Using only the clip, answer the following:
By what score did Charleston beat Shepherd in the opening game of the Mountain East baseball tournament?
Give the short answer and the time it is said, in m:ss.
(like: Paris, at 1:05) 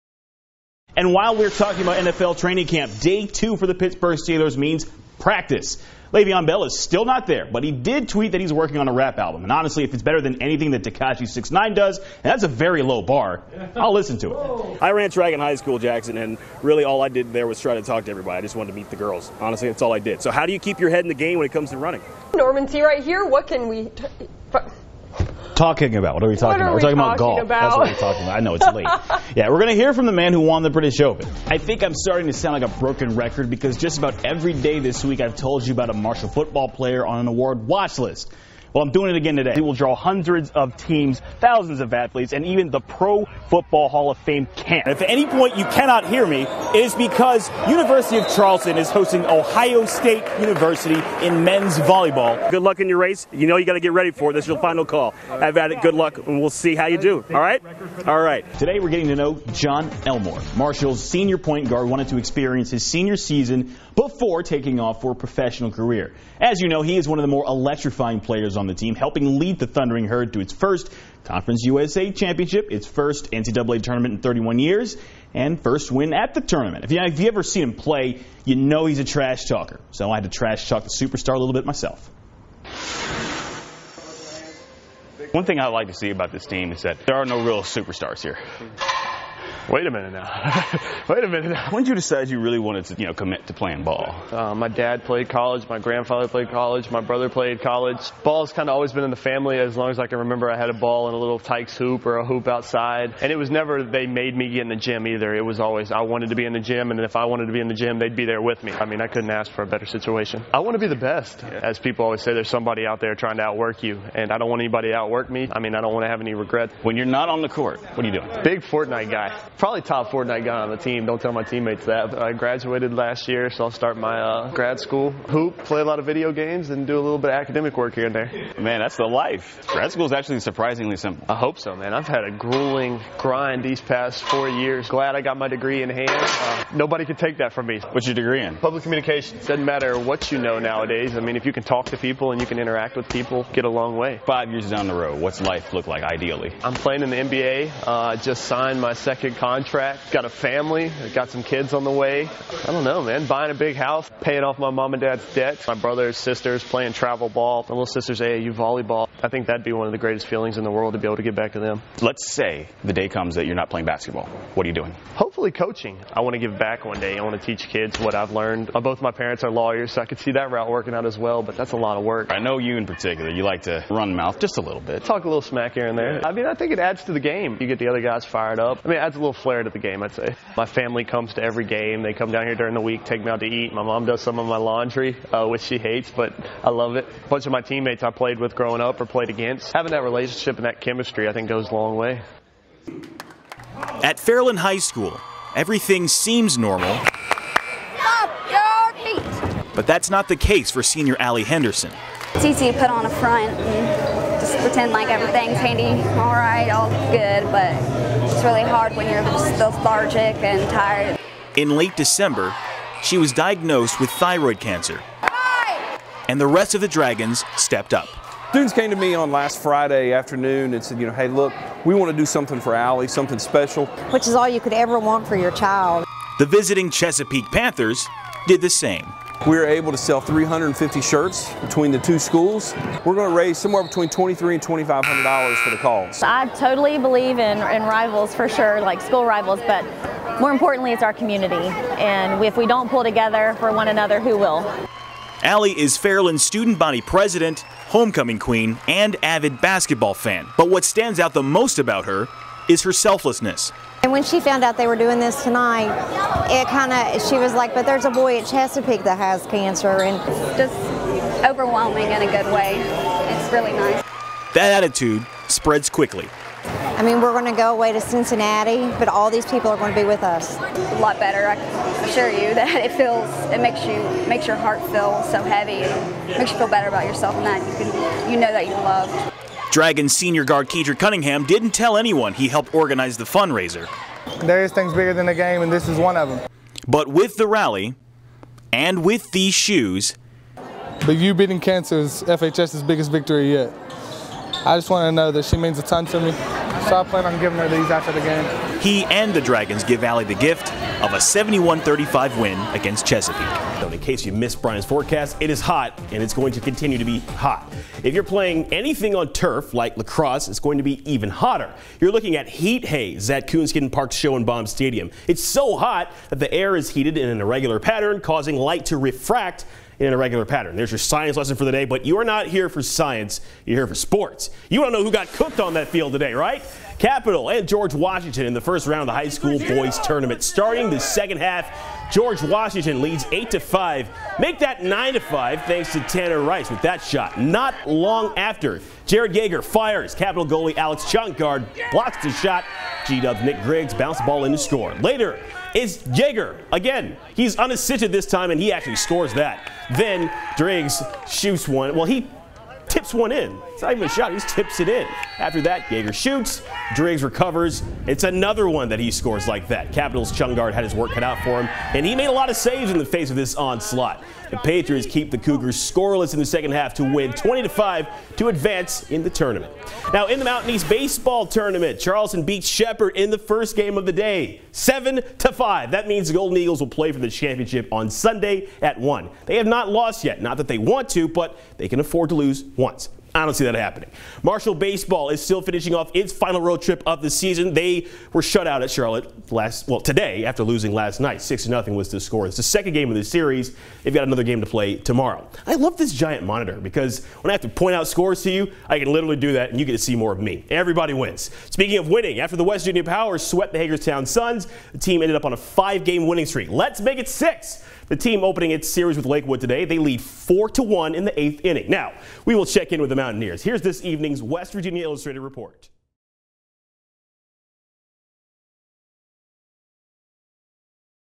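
7 to 5, at 6:14.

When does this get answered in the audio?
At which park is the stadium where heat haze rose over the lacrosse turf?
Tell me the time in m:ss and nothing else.
5:13.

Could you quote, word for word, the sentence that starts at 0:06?
Le'Veon Bell is still not there, but he did tweet that he's working on a rap album.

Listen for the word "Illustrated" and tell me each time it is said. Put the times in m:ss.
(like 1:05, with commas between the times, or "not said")
6:55.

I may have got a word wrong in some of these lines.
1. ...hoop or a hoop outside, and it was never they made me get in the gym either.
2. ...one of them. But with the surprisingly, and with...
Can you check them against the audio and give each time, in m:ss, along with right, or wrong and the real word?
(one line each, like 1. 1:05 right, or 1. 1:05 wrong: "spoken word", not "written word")
1. 1:41 right
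2. 4:45 wrong: "rally", not "surprisingly".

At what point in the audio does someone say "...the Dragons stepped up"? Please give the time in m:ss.
3:36.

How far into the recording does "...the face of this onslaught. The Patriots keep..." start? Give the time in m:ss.
6:02.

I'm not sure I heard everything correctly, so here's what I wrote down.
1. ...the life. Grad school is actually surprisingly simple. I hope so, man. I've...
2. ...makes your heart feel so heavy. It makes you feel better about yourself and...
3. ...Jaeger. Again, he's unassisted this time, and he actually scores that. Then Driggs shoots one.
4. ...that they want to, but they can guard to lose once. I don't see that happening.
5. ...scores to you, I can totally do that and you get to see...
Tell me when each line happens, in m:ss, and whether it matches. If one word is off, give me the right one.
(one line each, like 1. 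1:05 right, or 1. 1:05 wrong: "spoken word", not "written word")
1. 2:08 right
2. 4:34 right
3. 5:46 right
4. 6:20 wrong: "afford", not "guard"
5. 6:38 wrong: "literally", not "totally".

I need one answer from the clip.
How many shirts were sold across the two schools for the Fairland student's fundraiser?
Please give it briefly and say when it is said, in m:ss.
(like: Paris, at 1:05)
350, at 3:50.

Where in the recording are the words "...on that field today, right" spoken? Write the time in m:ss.
5:25.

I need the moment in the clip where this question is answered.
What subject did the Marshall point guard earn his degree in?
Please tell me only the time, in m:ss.
2:18.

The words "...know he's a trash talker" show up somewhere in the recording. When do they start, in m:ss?
1:18.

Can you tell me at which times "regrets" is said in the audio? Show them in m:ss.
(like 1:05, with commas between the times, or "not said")
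1:56.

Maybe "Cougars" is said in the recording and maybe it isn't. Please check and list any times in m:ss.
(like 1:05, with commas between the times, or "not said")
6:05.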